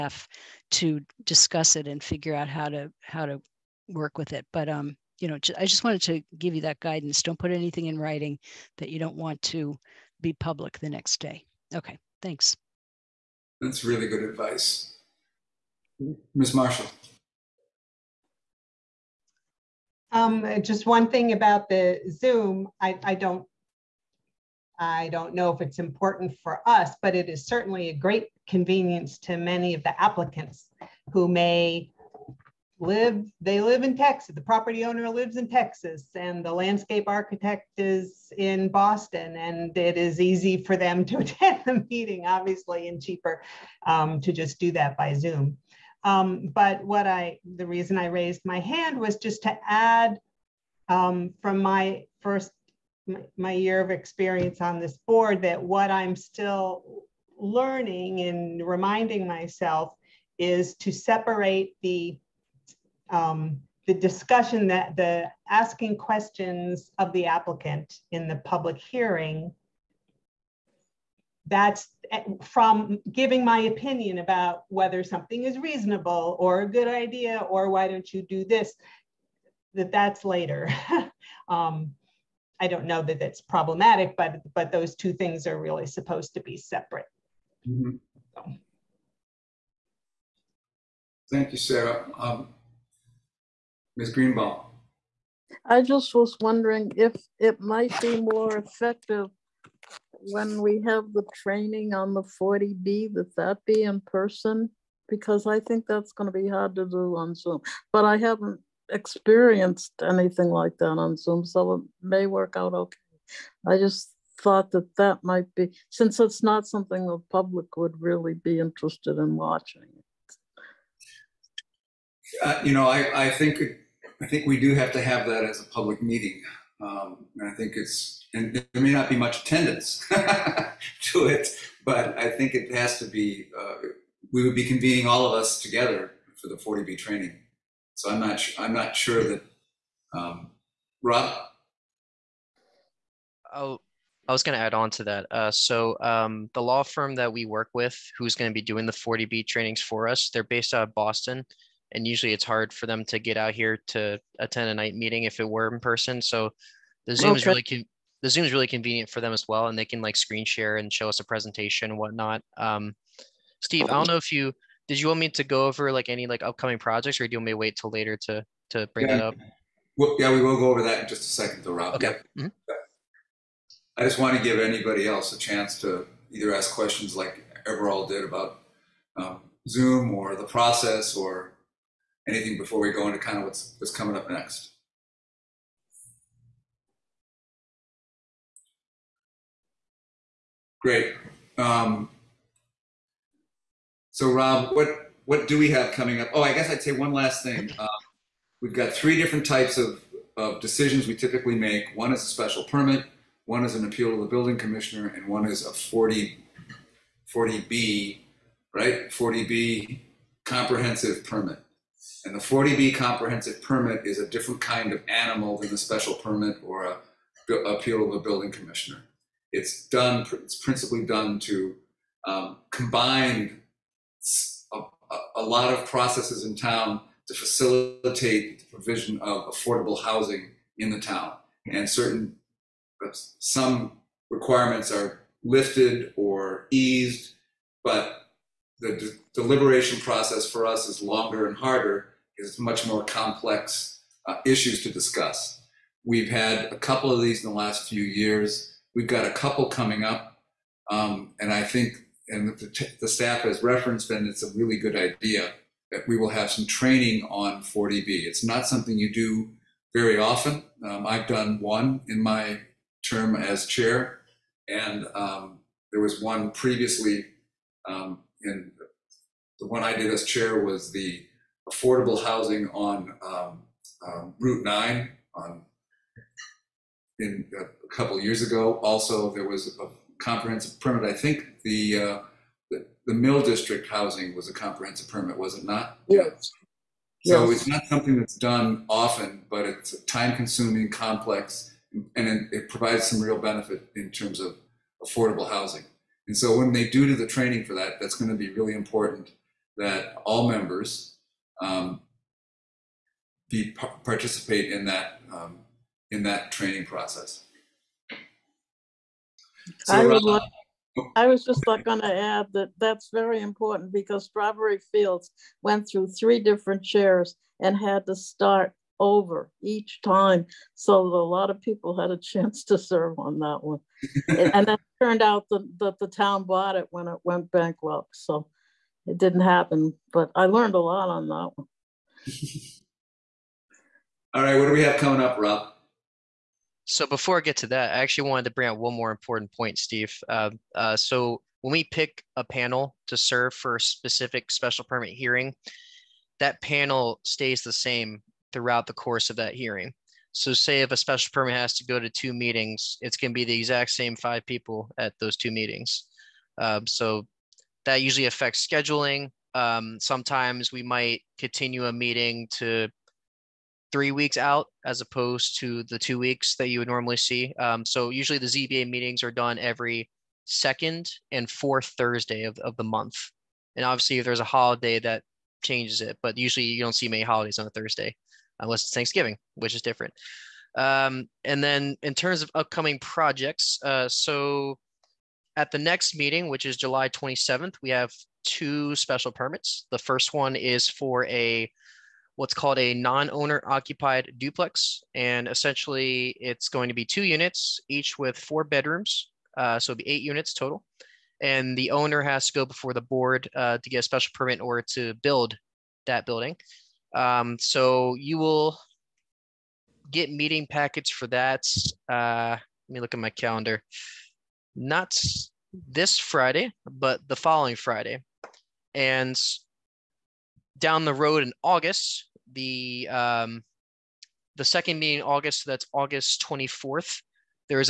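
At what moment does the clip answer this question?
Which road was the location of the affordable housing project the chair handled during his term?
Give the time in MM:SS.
04:34.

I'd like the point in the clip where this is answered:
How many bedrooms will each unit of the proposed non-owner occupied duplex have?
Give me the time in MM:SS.
06:38.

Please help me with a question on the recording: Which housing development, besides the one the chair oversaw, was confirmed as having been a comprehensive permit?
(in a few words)
Mill District housing.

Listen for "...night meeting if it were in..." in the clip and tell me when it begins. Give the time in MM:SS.
02:34.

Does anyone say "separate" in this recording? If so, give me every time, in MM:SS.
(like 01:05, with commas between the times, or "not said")
01:00, 01:26.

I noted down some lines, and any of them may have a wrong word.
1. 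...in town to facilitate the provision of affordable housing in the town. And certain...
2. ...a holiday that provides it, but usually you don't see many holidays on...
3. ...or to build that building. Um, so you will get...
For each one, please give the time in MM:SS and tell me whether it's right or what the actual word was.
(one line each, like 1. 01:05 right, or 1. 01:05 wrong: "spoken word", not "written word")
1. 03:46 right
2. 06:14 wrong: "changes", not "provides"
3. 06:44 right.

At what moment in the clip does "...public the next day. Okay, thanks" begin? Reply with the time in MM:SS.
00:10.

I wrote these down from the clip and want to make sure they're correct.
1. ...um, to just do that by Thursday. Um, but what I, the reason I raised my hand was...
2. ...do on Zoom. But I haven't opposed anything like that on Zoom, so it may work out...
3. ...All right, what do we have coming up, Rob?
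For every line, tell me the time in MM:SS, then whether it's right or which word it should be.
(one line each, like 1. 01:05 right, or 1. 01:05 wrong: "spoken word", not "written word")
1. 00:43 wrong: "Zoom", not "Thursday"
2. 01:46 wrong: "experienced", not "opposed"
3. 05:34 right.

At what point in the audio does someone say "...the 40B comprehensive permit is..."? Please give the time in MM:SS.
03:32.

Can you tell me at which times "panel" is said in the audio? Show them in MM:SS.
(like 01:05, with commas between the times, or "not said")
05:42, 05:46.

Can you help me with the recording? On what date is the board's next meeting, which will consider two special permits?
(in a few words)
July 27th.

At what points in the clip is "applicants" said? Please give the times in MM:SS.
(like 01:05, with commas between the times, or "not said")
00:30, 01:07.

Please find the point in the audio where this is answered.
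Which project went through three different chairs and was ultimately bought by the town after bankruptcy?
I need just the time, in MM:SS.
05:14.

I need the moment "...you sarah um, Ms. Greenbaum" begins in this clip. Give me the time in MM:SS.
01:31.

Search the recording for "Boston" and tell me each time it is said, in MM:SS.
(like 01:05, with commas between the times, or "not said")
00:38, 02:30.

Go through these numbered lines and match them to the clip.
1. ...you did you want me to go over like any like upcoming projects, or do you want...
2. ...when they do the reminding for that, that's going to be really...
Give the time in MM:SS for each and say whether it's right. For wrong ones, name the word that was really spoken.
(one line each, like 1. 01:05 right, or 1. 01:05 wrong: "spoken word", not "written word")
1. 02:44 right
2. 04:56 wrong: "training", not "reminding".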